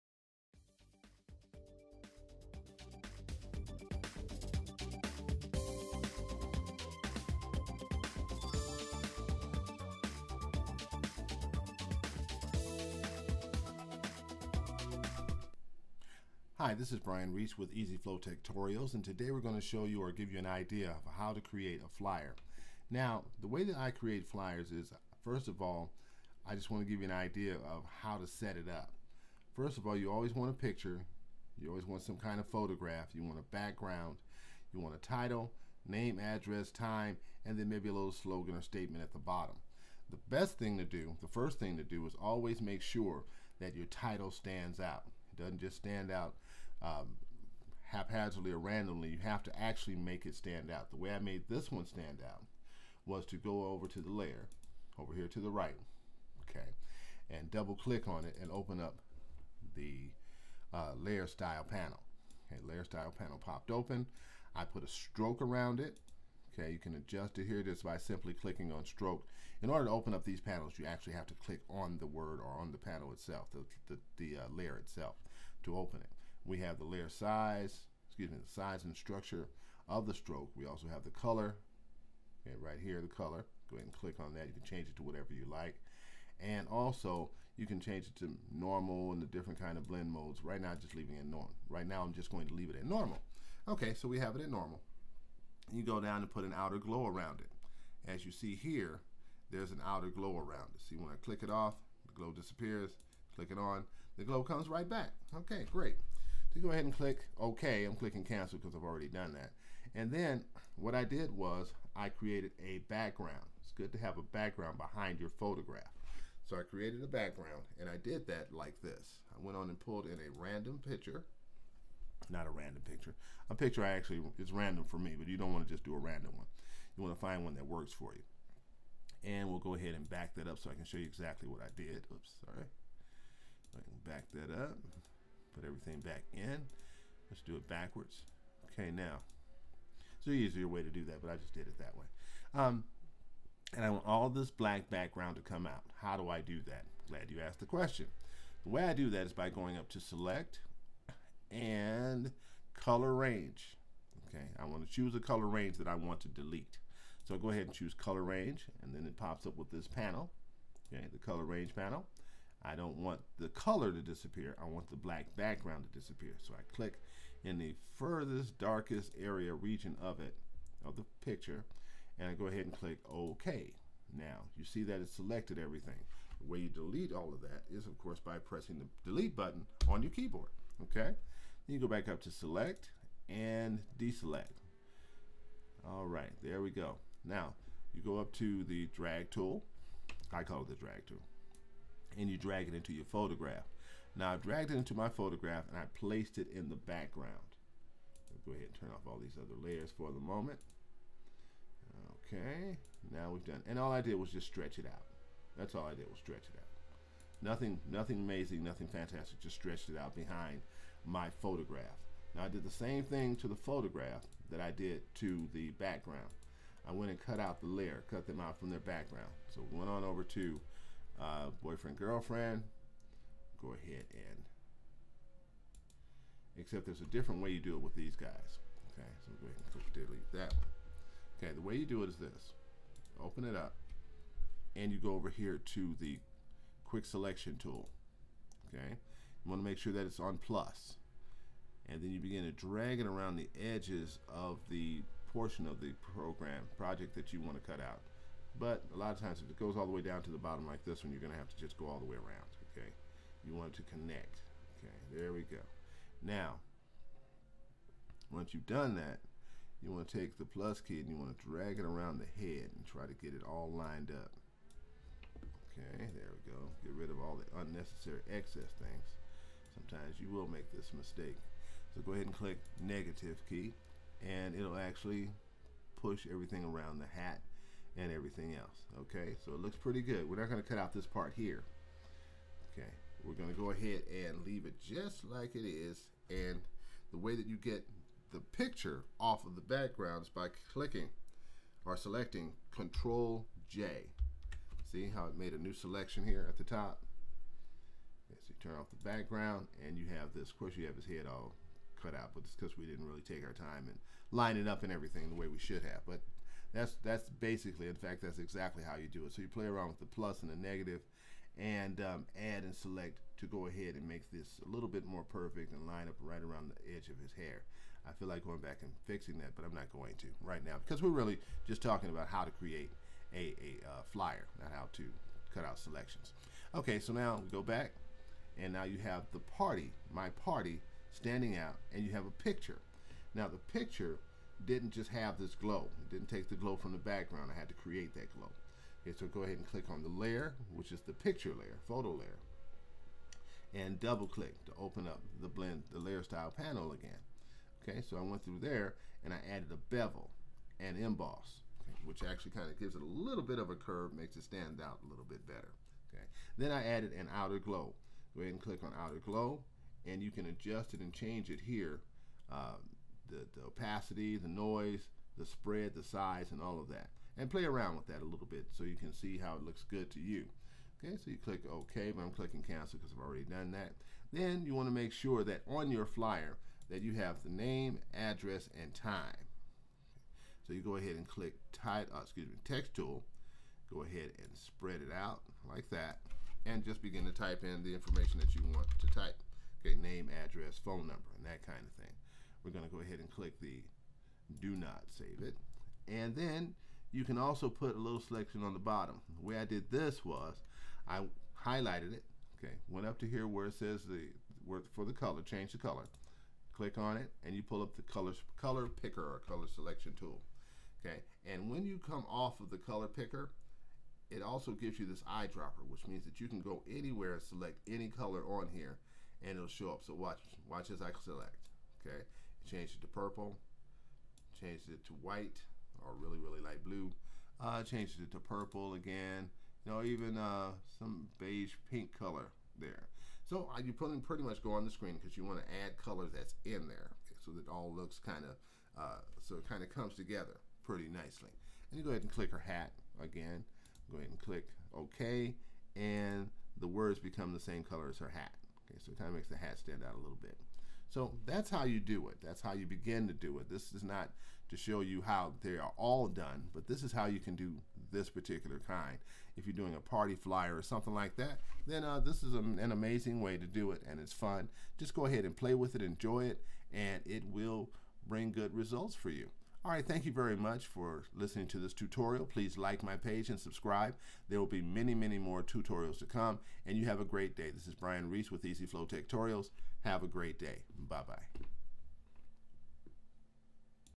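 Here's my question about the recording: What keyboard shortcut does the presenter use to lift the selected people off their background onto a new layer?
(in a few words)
Control J.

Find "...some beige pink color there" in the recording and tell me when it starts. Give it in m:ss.
7:10.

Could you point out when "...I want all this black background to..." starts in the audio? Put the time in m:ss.
2:23.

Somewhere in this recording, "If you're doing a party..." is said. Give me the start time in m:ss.
7:39.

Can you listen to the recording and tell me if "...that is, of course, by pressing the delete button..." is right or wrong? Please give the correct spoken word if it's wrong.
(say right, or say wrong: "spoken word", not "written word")
right.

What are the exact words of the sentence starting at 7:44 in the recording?
Just go ahead and play with it, enjoy it, and it will bring good results for you.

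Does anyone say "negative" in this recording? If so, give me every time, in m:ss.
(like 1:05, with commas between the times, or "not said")
4:32, 5:10.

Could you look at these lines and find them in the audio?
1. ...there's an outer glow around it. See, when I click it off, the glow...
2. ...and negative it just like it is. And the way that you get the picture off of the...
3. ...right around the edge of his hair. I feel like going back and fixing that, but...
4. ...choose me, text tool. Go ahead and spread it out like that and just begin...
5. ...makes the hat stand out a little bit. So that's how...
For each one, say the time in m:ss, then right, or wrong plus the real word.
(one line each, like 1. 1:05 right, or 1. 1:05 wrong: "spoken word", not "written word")
1. 1:39 right
2. 4:44 wrong: "leave", not "negative"
3. 5:16 right
4. 6:22 wrong: "excuse", not "choose"
5. 7:29 right.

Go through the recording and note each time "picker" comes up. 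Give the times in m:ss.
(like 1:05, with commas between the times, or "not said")
6:49, 6:53.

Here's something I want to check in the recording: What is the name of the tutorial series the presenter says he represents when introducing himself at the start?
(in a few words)
EasyFlow Tutorials.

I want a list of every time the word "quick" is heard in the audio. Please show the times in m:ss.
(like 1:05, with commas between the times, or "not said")
3:56.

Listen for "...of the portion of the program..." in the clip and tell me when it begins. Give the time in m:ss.
4:04.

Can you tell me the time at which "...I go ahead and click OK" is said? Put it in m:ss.
2:52.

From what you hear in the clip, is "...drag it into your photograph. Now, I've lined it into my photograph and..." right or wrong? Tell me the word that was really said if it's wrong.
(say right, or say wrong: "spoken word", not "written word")
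wrong: "dragged", not "lined".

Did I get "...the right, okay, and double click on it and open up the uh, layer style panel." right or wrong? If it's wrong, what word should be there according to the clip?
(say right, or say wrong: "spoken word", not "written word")
right.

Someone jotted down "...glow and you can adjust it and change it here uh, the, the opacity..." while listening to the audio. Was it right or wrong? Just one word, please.
right.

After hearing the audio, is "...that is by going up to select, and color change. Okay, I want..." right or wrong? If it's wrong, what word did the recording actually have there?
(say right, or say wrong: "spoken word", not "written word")
wrong: "range", not "change".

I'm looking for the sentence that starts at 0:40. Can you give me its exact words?
The best thing to do, the first thing to do is always make sure that your title stands out.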